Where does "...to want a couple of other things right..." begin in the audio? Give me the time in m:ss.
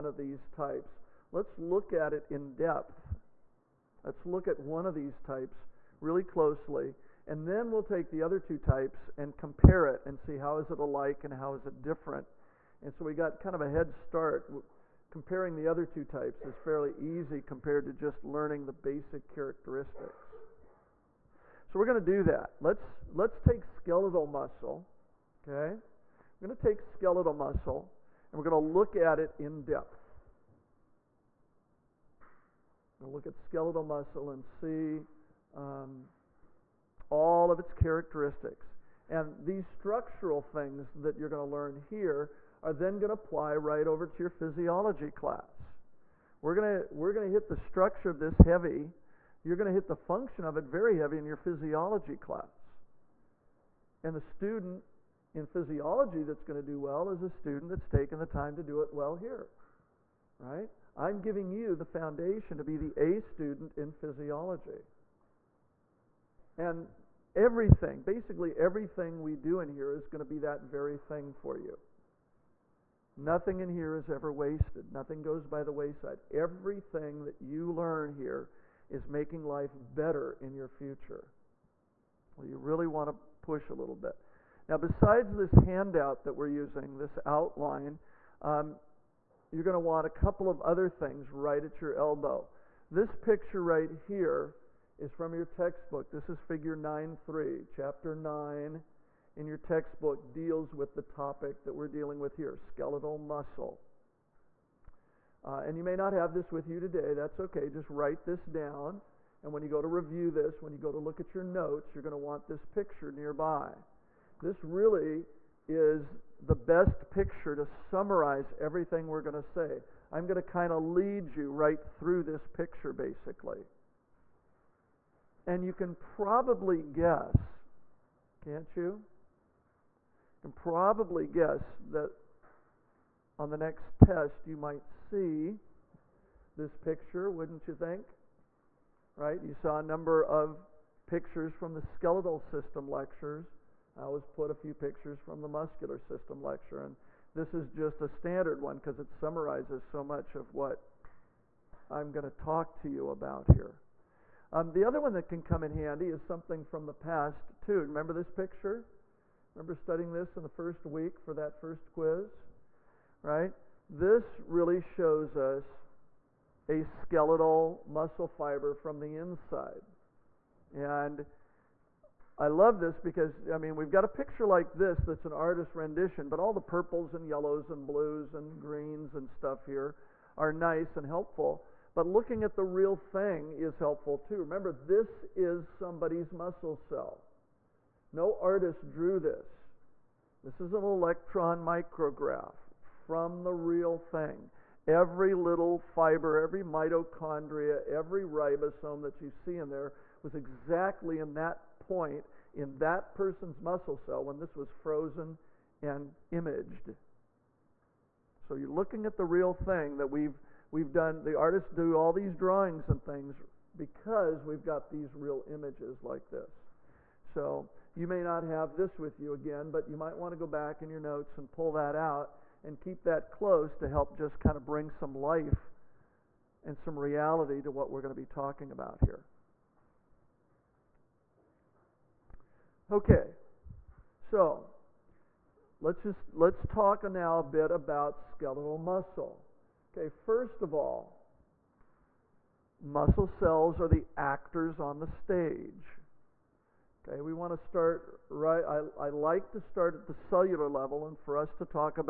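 1:29.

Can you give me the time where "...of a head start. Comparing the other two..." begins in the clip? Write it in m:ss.
0:13.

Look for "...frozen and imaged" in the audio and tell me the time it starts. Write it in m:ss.
3:24.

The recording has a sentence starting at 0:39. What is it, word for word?
And these structural things that you're going to learn here are then going to apply right over to your physiology class.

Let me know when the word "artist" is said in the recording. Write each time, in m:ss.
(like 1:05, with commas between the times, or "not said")
2:55, 3:08, 3:31.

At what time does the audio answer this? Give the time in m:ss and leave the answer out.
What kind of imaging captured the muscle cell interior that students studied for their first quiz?
3:10.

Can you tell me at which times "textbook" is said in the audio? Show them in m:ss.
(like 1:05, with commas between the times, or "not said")
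1:35, 1:39.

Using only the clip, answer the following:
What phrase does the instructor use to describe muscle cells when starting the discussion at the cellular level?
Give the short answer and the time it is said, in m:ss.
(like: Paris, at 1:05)
The actors on the stage, at 4:03.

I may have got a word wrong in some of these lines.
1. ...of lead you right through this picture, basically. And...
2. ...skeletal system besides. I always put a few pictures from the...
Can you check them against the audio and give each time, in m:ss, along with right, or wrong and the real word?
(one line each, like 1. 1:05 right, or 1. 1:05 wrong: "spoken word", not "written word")
1. 2:00 right
2. 2:21 wrong: "lectures", not "besides".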